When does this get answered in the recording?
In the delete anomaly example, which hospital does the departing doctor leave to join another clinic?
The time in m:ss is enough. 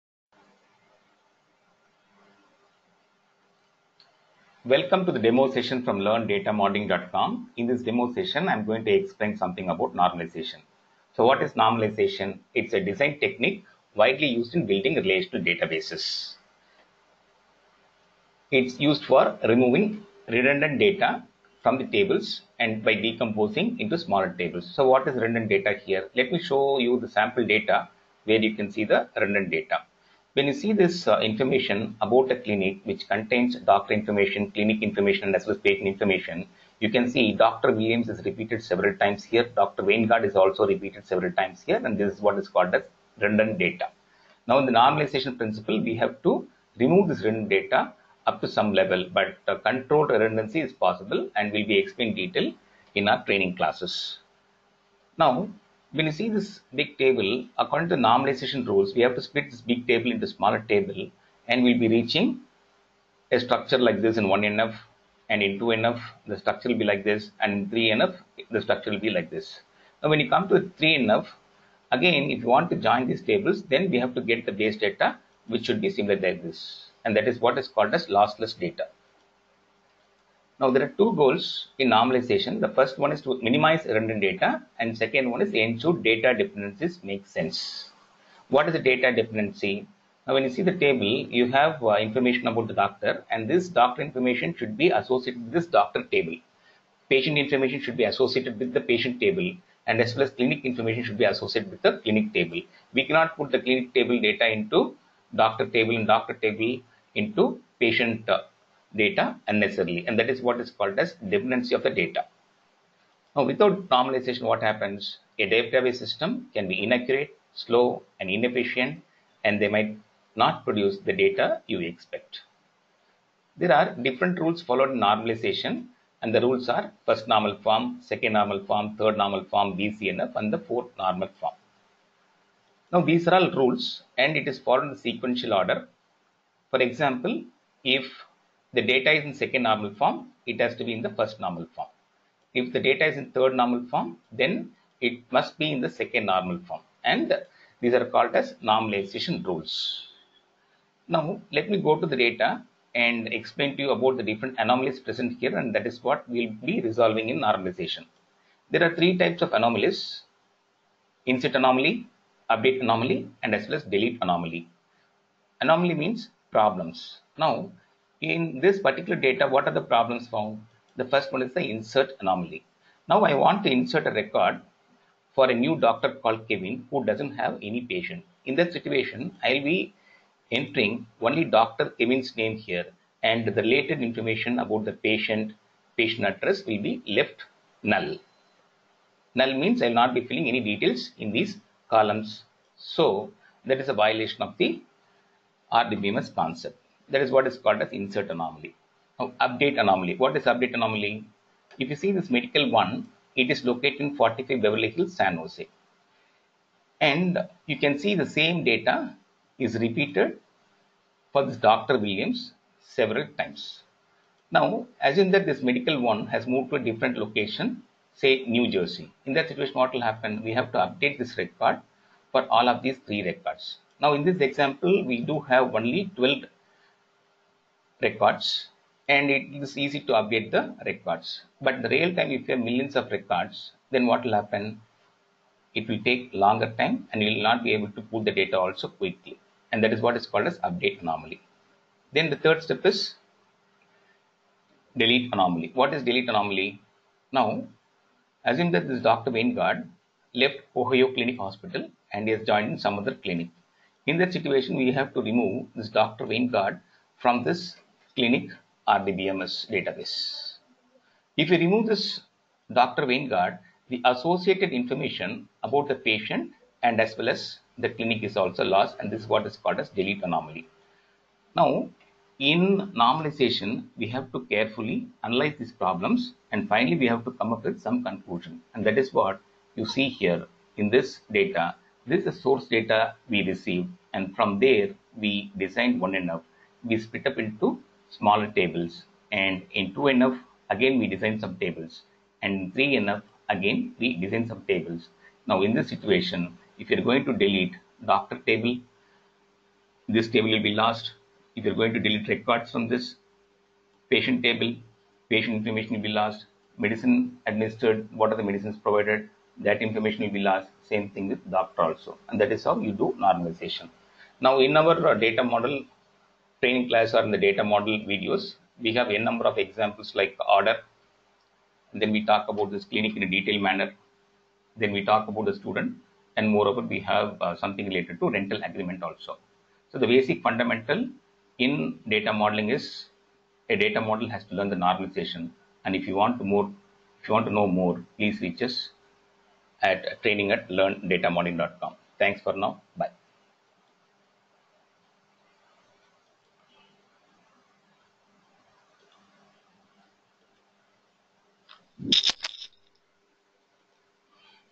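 4:10.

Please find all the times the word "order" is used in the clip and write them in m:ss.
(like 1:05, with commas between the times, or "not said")
2:15, 5:20.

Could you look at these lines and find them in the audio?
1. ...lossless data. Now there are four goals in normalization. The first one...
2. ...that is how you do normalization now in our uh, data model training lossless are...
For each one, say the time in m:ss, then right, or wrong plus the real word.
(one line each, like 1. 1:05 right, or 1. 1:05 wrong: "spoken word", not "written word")
1. 1:18 wrong: "two", not "four"
2. 5:12 wrong: "class", not "lossless".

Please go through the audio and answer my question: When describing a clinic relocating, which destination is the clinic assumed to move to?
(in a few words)
New Jersey.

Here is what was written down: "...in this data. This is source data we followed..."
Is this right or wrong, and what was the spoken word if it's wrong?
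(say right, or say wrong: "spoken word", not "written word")
wrong: "received", not "followed".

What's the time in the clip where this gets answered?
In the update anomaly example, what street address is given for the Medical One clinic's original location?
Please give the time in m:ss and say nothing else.
3:24.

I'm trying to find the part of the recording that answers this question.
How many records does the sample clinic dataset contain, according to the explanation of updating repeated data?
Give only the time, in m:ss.
3:46.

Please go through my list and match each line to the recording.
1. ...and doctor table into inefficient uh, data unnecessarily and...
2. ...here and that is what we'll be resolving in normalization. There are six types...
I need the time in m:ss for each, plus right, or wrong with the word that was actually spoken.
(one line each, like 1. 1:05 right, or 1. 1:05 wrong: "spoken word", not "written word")
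1. 1:45 wrong: "patient", not "inefficient"
2. 2:35 wrong: "three", not "six".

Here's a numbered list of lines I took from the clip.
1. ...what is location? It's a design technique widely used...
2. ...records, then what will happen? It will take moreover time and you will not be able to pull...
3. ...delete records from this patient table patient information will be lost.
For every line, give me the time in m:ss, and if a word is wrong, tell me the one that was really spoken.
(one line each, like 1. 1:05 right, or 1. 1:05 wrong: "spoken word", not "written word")
1. 0:11 wrong: "normalization", not "location"
2. 3:53 wrong: "longer", not "moreover"
3. 5:01 right.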